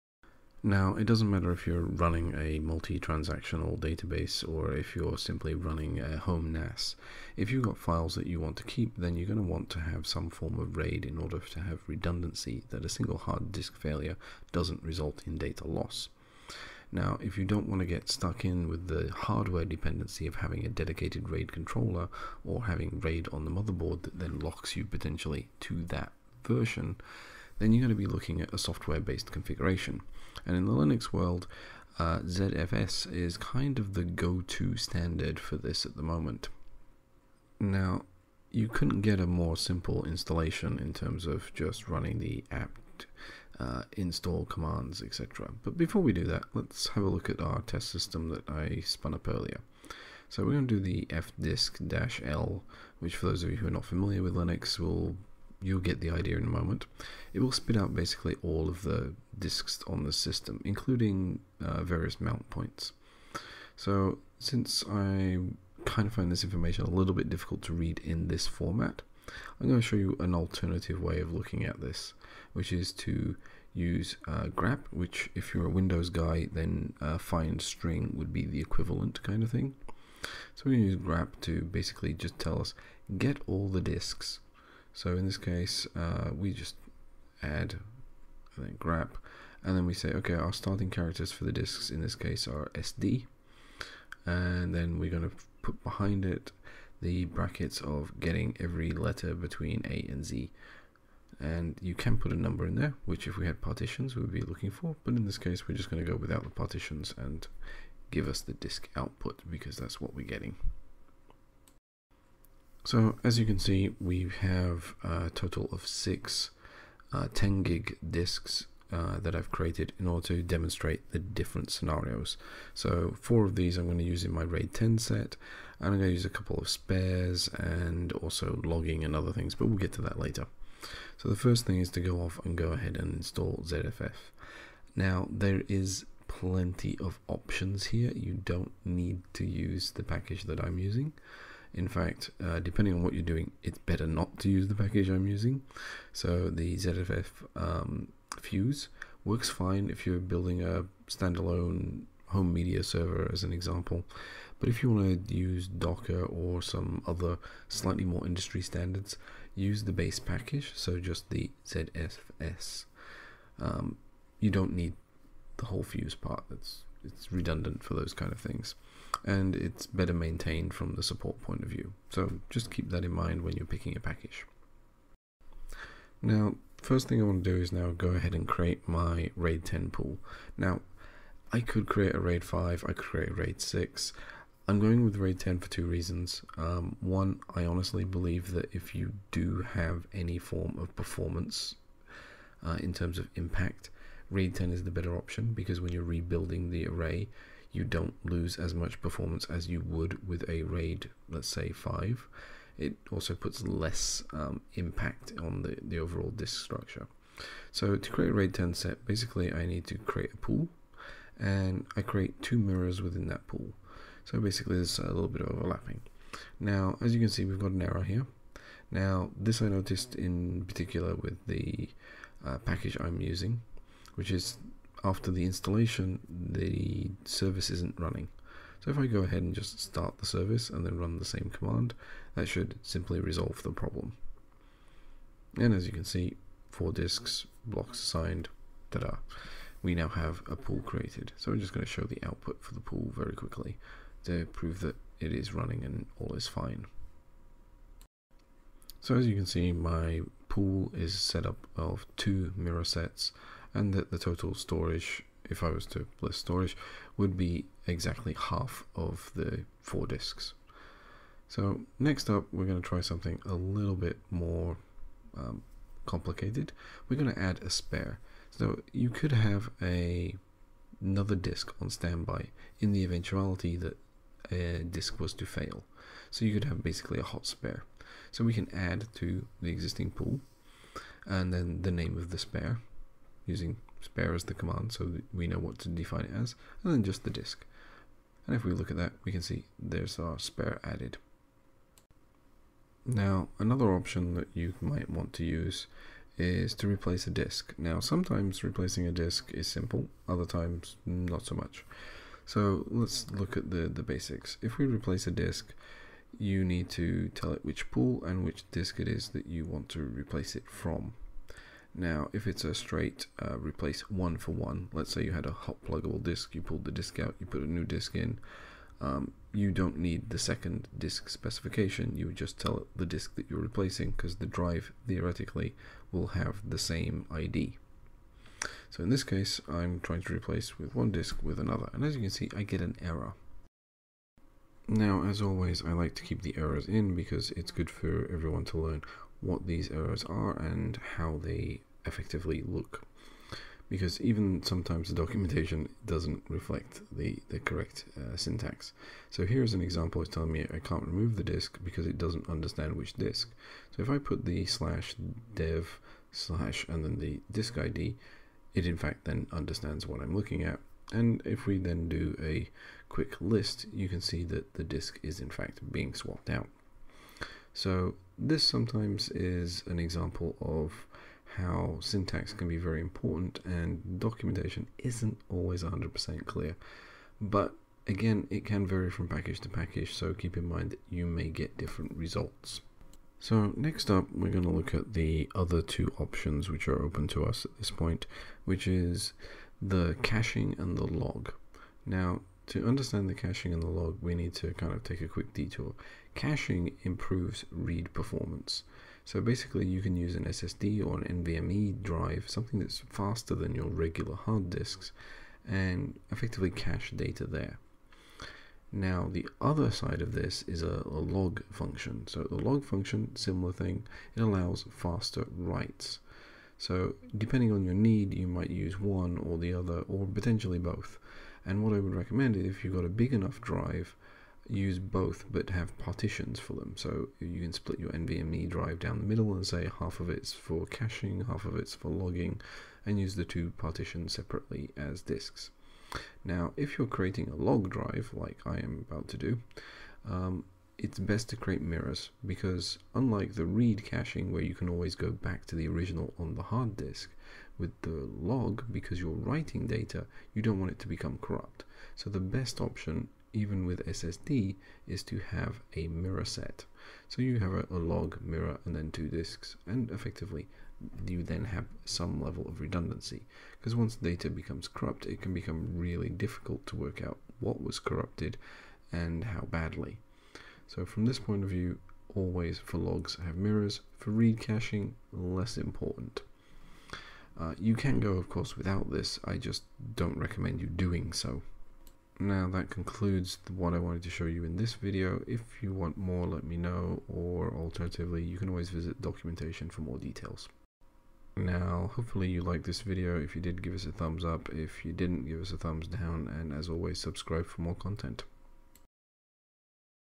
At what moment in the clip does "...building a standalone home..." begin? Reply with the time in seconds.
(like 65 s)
150 s.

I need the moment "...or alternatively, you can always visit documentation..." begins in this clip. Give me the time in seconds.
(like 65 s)
487 s.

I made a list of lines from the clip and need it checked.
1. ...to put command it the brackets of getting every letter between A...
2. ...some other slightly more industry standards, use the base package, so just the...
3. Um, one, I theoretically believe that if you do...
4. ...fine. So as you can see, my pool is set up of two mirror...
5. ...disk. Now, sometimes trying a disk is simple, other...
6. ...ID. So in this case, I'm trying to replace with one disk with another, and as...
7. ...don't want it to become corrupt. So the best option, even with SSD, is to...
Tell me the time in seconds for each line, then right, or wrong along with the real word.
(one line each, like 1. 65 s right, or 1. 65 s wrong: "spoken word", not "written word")
1. 95 s wrong: "behind", not "command"
2. 156 s right
3. 186 s wrong: "honestly", not "theoretically"
4. 246 s right
5. 297 s wrong: "replacing", not "trying"
6. 327 s right
7. 450 s right.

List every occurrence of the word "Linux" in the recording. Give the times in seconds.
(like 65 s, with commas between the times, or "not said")
30 s, 54 s.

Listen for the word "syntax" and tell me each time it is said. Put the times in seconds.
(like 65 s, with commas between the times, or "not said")
348 s, 371 s.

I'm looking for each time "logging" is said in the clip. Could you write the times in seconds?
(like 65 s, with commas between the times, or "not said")
128 s, 432 s.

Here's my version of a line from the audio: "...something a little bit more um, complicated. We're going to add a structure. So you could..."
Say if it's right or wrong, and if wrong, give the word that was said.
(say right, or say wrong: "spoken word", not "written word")
wrong: "spare", not "structure".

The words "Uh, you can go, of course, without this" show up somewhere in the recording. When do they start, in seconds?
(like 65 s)
477 s.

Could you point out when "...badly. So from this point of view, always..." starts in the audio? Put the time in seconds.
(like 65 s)
469 s.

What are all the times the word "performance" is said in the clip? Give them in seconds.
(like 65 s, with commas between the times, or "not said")
190 s, 199 s, 398 s.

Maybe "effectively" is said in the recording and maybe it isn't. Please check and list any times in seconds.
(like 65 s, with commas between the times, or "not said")
342 s, 406 s, 460 s.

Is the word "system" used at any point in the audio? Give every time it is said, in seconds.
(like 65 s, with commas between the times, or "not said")
47 s, 60 s.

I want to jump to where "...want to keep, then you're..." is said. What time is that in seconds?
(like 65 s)
8 s.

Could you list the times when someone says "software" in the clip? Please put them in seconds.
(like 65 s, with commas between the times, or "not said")
28 s.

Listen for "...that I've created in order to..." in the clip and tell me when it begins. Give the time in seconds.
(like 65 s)
119 s.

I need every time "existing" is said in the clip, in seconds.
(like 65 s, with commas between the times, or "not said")
279 s.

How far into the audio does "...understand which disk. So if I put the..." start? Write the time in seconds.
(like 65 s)
352 s.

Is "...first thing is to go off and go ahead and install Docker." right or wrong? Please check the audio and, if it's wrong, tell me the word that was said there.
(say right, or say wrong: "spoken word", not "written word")
wrong: "ZFS", not "Docker".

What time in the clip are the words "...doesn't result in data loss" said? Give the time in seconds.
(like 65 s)
14 s.